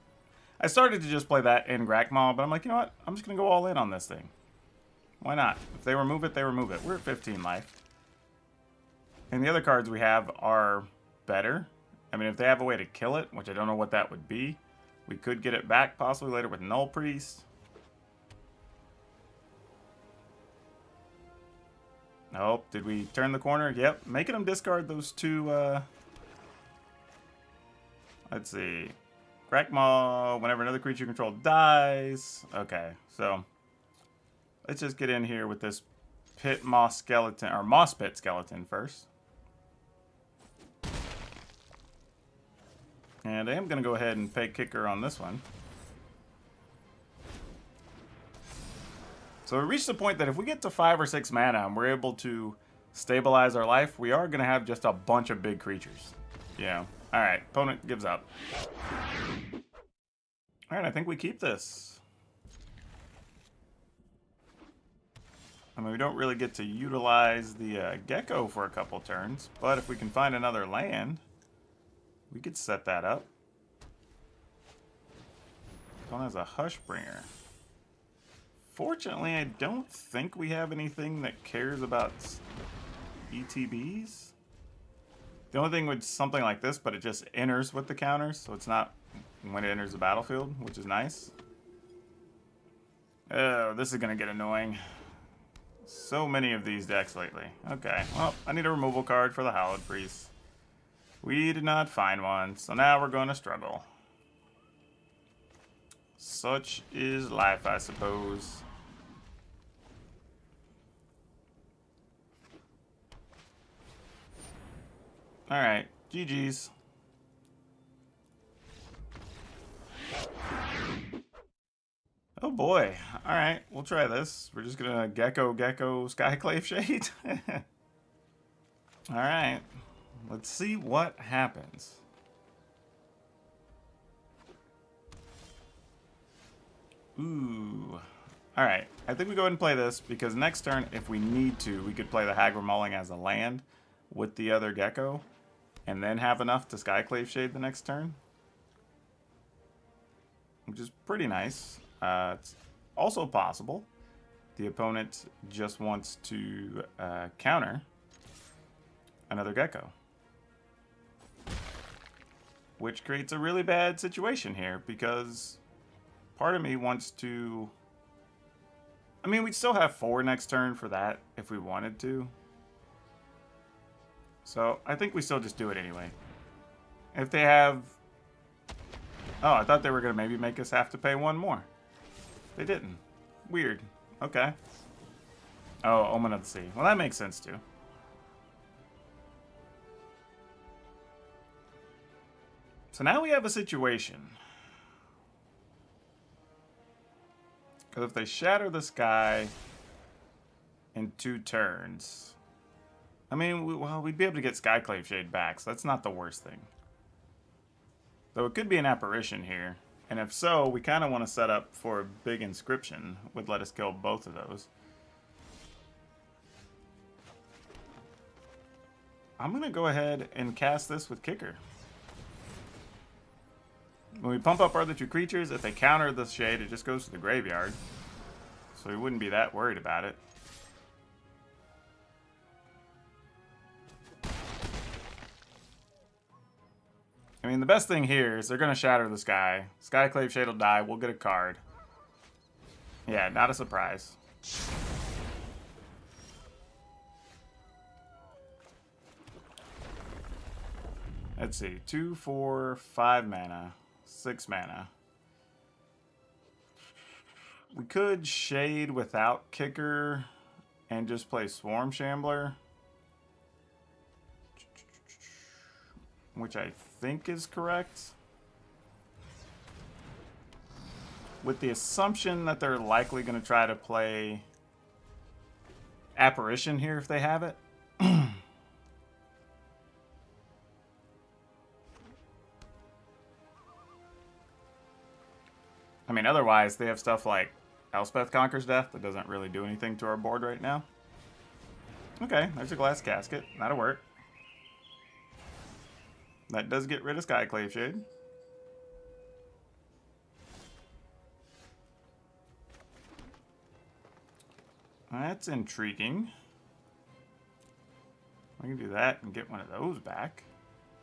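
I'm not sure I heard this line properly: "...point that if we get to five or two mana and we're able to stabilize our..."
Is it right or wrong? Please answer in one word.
wrong.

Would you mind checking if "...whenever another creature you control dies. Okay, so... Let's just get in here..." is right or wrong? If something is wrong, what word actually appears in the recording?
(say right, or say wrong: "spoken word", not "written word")
right.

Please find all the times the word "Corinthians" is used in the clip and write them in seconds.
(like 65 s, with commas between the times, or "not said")
not said.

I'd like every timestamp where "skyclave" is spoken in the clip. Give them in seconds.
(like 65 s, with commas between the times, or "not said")
126 s, 146 s, 204 s, 239 s, 297 s.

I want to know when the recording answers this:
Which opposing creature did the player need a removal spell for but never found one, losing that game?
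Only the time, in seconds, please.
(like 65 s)
99 s.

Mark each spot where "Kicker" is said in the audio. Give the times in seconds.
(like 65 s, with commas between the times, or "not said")
44 s, 221 s, 259 s.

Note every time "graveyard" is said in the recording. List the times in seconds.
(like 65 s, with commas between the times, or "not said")
227 s.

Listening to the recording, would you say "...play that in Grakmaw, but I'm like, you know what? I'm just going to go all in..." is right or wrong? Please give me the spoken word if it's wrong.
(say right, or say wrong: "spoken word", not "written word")
right.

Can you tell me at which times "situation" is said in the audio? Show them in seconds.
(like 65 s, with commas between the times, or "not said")
163 s, 193 s.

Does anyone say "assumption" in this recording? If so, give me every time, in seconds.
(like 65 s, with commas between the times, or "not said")
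271 s.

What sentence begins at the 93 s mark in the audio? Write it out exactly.
Oh, this is going to get annoying.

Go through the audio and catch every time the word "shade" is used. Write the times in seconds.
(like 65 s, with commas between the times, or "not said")
126 s, 147 s, 205 s, 226 s, 240 s, 258 s, 297 s.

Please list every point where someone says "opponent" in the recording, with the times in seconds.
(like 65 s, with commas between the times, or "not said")
57 s, 154 s.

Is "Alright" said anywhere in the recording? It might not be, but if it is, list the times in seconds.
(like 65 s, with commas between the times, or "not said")
115 s, 123 s, 129 s, 138 s.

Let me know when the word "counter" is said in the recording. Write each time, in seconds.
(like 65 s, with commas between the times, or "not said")
87 s, 157 s, 225 s.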